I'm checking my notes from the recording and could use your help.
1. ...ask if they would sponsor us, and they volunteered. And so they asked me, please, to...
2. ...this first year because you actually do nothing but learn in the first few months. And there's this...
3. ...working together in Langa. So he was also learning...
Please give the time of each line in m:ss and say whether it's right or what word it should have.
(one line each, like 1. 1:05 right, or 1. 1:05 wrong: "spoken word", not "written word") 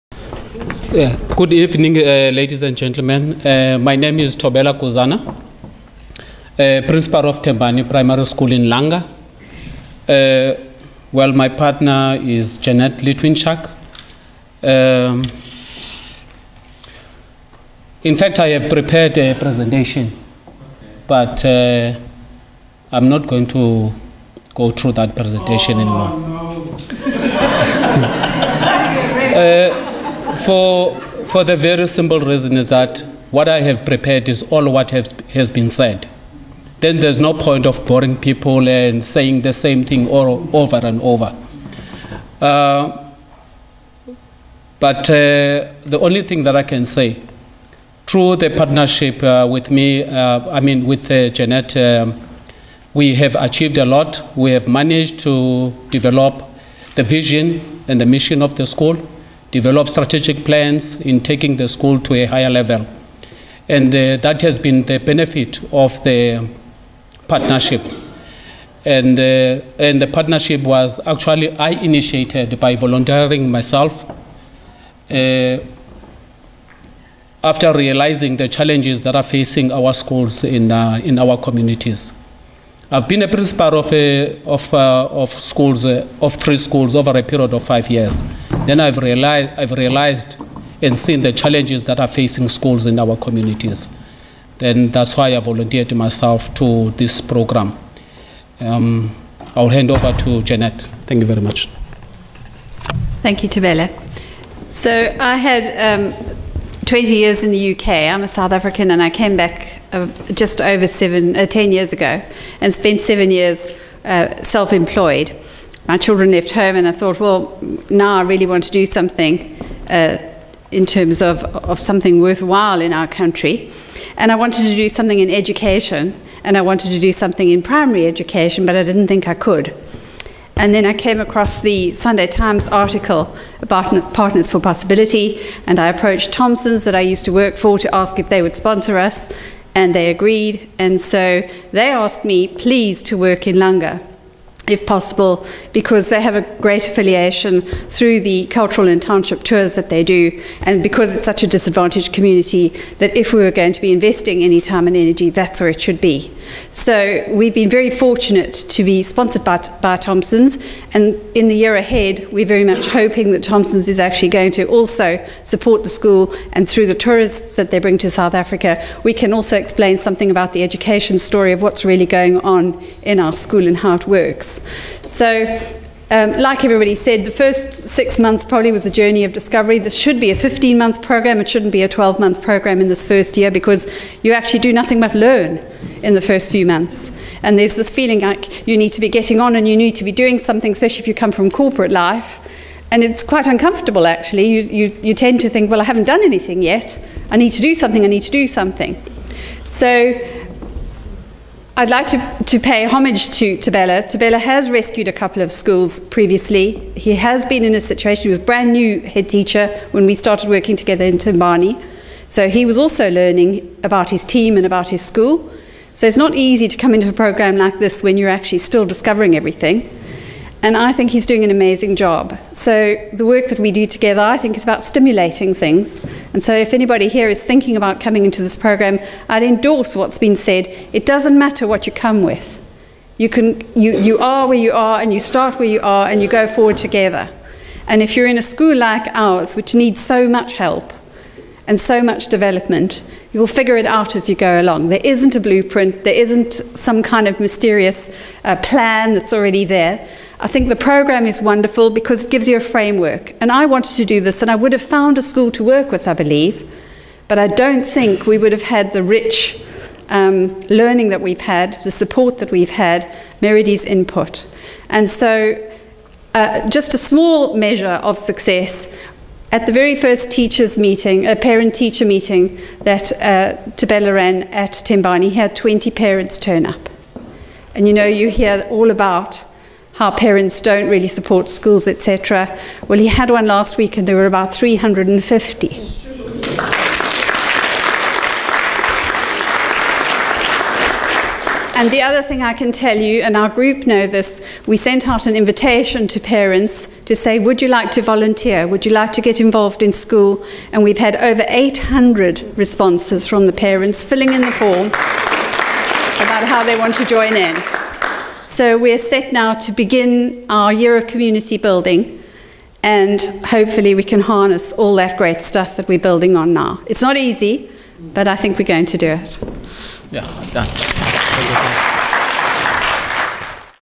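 1. 2:17 wrong: "agreed", not "volunteered"
2. 3:02 right
3. 3:30 wrong: "Tembani", not "Langa".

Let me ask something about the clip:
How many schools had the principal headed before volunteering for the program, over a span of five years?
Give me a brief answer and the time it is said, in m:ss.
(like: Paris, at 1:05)
3, at 1:26.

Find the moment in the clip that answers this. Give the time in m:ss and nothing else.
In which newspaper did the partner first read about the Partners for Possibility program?
2:11.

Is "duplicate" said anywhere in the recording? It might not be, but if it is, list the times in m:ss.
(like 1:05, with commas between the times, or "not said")
not said.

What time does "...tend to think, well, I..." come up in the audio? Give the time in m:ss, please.
3:15.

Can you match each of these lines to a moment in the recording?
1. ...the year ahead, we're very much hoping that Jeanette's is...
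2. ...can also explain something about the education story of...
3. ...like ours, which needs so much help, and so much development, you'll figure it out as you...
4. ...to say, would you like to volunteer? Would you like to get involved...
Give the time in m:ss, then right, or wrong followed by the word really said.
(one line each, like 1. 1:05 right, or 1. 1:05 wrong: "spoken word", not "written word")
1. 2:41 wrong: "Thompson", not "Jeanette"
2. 2:49 right
3. 3:58 right
4. 4:57 right.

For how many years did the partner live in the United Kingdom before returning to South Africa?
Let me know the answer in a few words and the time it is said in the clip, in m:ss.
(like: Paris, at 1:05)
20, at 1:46.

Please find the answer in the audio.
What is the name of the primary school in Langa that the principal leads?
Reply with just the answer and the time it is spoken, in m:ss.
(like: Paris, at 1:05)
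Tembani Primary School, at 0:07.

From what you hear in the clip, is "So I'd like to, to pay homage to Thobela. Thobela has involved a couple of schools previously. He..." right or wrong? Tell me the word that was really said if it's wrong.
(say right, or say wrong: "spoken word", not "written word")
wrong: "rescued", not "involved".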